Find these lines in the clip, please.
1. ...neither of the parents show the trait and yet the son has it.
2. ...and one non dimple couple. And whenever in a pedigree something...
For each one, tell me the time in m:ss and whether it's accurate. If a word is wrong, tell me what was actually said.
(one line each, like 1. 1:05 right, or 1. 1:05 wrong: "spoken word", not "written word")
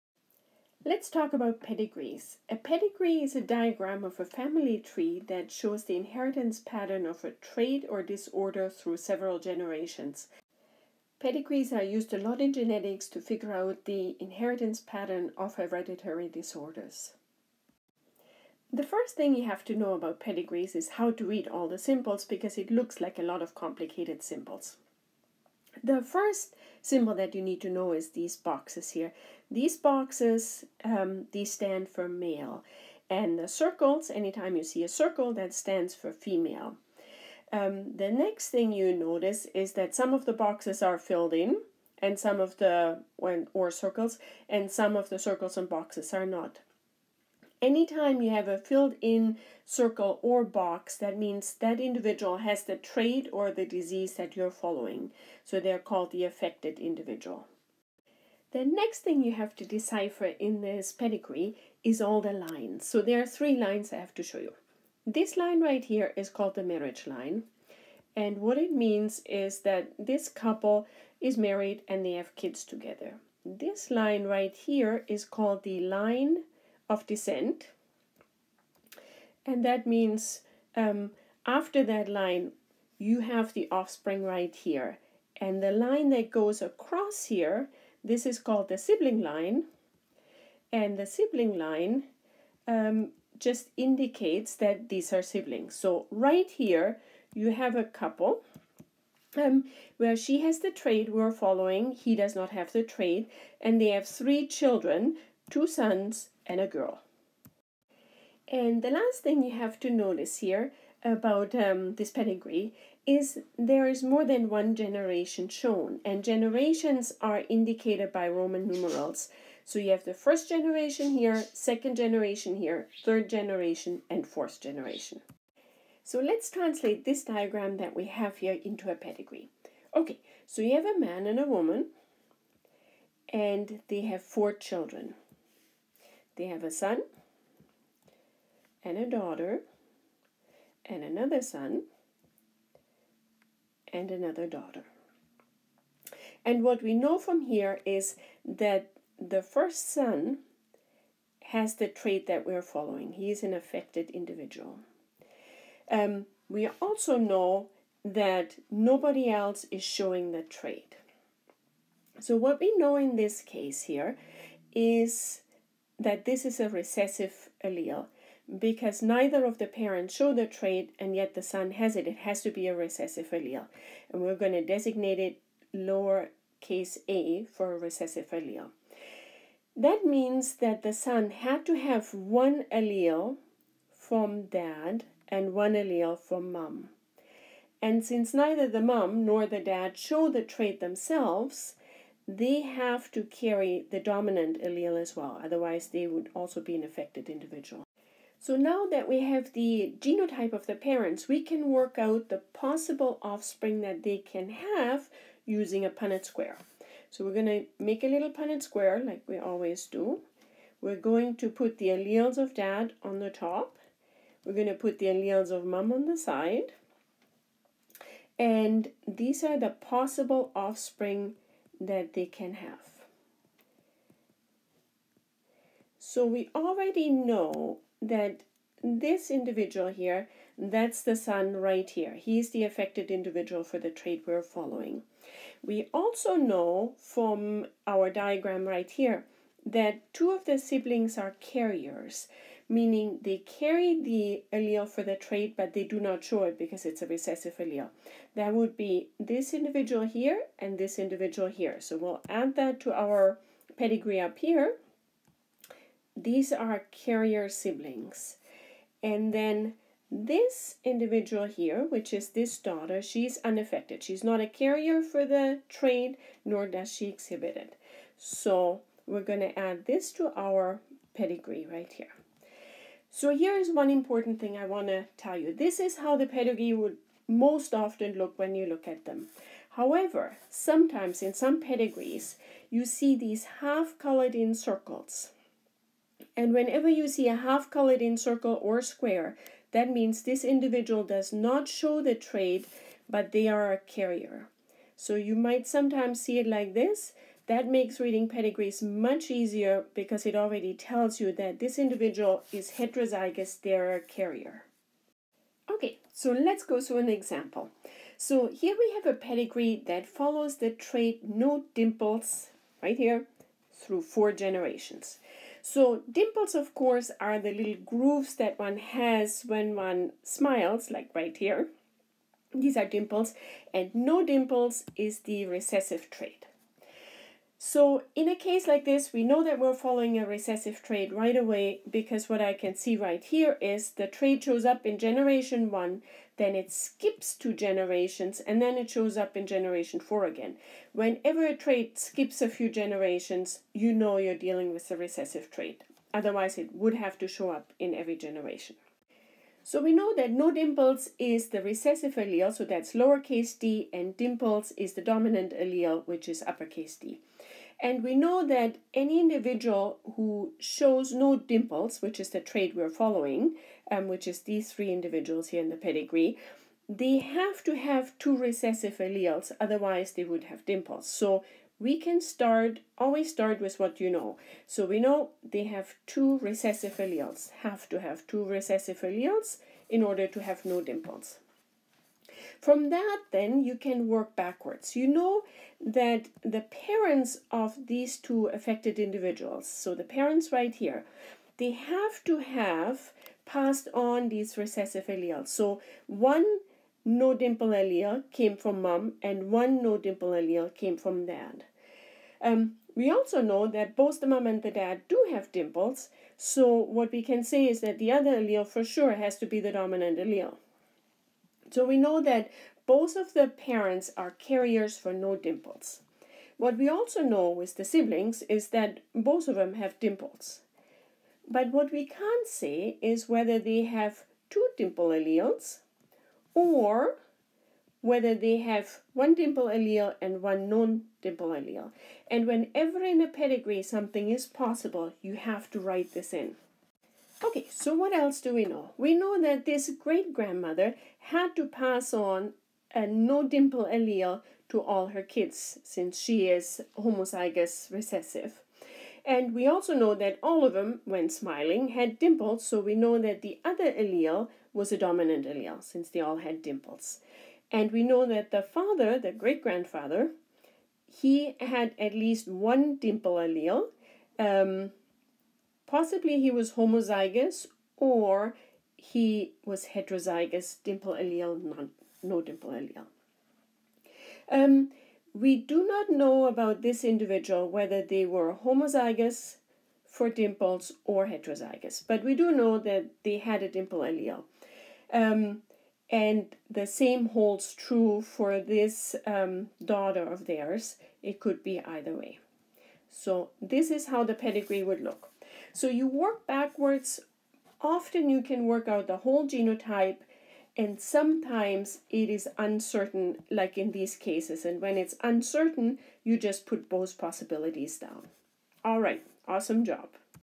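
1. 2:49 right
2. 7:10 wrong: "allele", not "couple".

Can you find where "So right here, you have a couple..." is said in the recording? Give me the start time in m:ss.
1:35.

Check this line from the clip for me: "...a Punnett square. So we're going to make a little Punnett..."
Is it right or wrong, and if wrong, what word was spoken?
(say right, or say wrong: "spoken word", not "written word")
right.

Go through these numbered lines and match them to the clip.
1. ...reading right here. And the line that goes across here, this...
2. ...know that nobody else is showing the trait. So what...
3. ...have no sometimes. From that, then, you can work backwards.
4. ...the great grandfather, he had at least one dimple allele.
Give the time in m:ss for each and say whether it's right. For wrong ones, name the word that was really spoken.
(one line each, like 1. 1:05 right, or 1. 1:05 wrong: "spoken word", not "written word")
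1. 1:23 wrong: "offspring", not "reading"
2. 2:37 right
3. 6:20 wrong: "dimples", not "sometimes"
4. 7:39 right.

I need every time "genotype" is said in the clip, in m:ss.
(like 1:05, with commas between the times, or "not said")
3:19, 8:19.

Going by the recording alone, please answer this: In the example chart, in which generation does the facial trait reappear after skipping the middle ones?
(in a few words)
generation 4.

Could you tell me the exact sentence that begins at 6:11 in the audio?
So we can start, always start with what you know.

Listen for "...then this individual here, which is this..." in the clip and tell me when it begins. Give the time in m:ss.
4:19.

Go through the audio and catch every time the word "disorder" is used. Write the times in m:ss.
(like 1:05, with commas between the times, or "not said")
0:08, 0:16.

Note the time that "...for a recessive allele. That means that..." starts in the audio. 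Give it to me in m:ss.
2:57.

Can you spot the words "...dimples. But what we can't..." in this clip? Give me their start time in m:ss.
6:59.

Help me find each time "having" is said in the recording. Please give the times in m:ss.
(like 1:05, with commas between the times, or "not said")
not said.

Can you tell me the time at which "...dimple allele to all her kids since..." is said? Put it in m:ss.
7:23.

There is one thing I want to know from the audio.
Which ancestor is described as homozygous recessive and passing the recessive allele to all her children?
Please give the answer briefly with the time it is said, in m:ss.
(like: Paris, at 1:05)
great grandmother, at 7:19.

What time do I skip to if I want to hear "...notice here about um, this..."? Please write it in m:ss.
1:49.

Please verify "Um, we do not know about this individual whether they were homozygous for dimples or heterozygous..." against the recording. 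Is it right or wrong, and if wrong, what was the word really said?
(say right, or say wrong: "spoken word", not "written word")
right.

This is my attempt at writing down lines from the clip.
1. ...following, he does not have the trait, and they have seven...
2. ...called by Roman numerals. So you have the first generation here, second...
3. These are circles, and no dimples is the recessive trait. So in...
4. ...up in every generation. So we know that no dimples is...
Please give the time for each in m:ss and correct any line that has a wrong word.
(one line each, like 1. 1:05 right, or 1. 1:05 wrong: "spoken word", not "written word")
1. 1:41 wrong: "three", not "seven"
2. 1:57 wrong: "indicated", not "called"
3. 5:22 wrong: "dimples", not "circles"
4. 5:47 right.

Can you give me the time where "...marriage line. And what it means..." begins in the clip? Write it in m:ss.
1:06.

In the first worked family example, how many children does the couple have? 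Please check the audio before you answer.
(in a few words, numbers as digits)
4.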